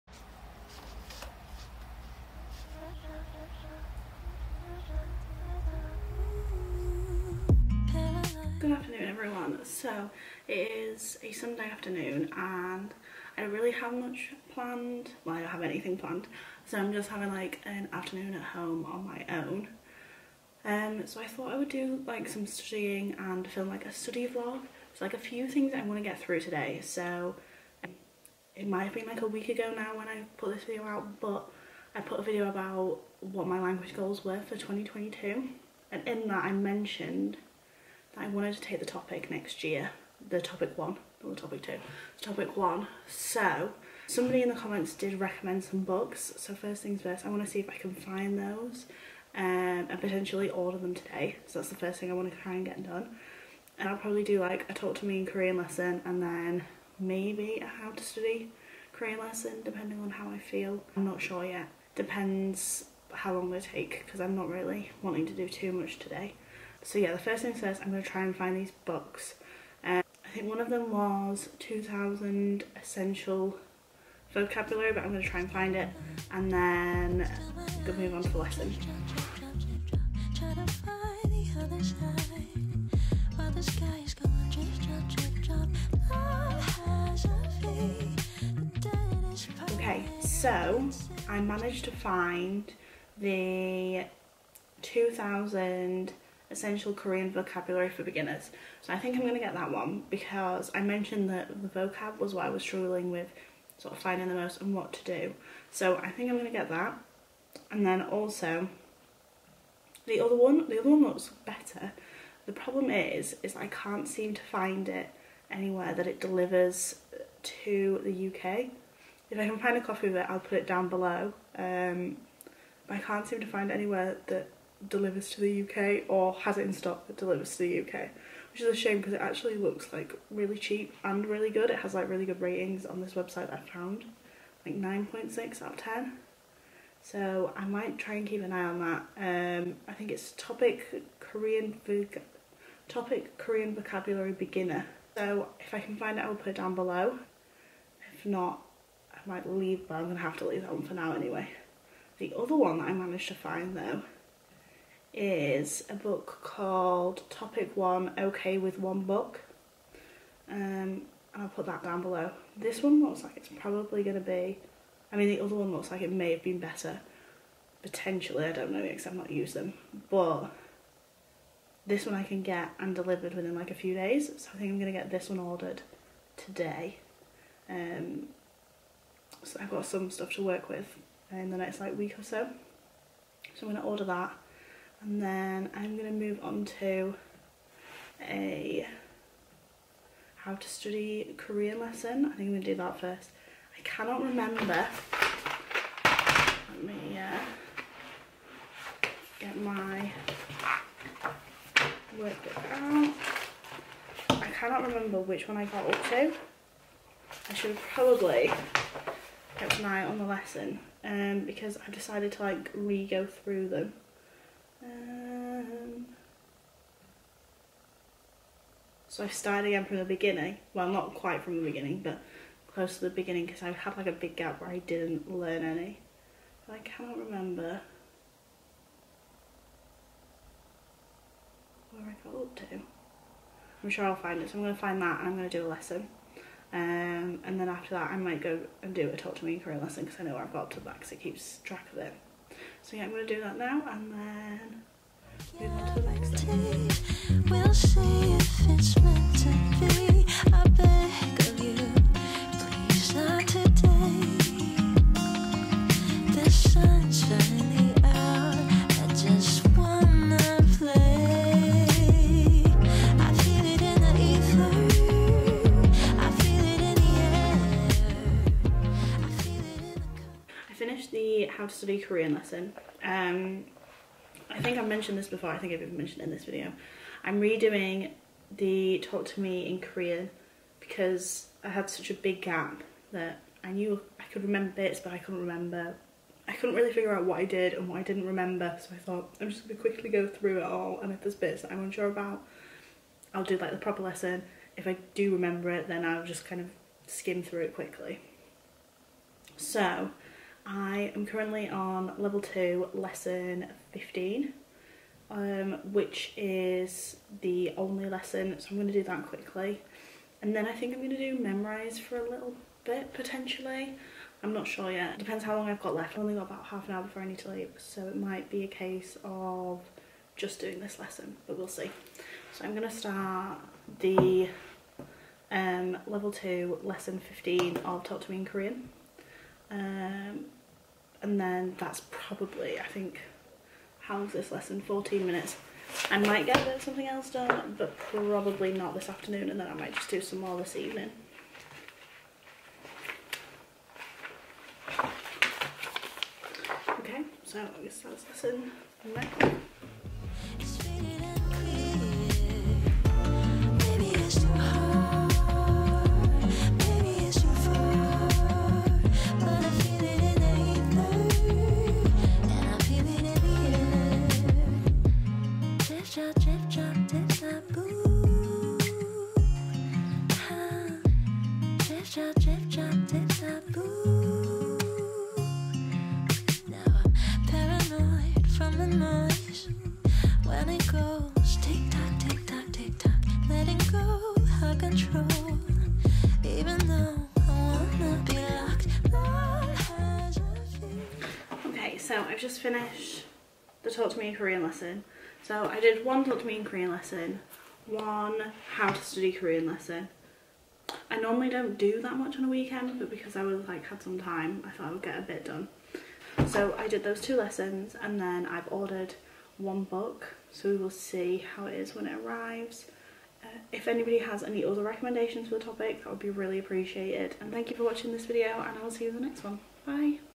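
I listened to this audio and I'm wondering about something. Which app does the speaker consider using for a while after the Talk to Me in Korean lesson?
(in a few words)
Memrise.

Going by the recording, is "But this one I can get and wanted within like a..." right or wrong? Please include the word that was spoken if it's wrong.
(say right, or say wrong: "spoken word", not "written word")
wrong: "delivered", not "wanted".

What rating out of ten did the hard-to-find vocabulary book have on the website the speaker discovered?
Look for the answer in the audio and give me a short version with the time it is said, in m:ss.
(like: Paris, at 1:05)
9.6, at 2:14.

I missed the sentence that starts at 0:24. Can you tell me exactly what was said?
It's like a few things I want to get through today.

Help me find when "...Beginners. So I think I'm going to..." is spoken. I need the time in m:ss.
1:38.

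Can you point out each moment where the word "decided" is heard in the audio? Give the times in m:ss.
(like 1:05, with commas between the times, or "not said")
3:31.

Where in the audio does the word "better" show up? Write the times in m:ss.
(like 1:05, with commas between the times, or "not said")
1:51, 2:46.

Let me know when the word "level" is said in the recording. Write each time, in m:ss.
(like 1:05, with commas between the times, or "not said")
5:02, 5:26.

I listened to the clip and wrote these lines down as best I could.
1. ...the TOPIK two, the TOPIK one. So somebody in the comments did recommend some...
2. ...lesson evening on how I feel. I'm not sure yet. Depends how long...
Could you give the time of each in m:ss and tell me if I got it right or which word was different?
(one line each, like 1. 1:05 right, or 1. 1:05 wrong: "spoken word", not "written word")
1. 0:41 right
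2. 0:59 wrong: "depending", not "evening".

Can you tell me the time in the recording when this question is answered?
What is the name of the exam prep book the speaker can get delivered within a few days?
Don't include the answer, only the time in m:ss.
2:37.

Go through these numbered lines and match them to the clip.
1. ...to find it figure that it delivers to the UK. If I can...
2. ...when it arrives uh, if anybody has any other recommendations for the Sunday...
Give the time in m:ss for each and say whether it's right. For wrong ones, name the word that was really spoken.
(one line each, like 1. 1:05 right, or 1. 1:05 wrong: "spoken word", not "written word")
1. 1:54 wrong: "anywhere", not "figure"
2. 6:51 wrong: "TOPIK", not "Sunday".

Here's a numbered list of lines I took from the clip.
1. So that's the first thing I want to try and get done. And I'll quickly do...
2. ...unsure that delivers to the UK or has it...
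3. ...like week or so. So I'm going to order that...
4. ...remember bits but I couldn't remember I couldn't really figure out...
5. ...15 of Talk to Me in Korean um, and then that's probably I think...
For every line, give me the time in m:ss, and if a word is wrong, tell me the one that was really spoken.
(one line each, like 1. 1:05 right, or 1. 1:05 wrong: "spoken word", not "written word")
1. 0:51 wrong: "probably", not "quickly"
2. 2:03 wrong: "anywhere", not "unsure"
3. 3:01 right
4. 4:44 right
5. 5:27 right.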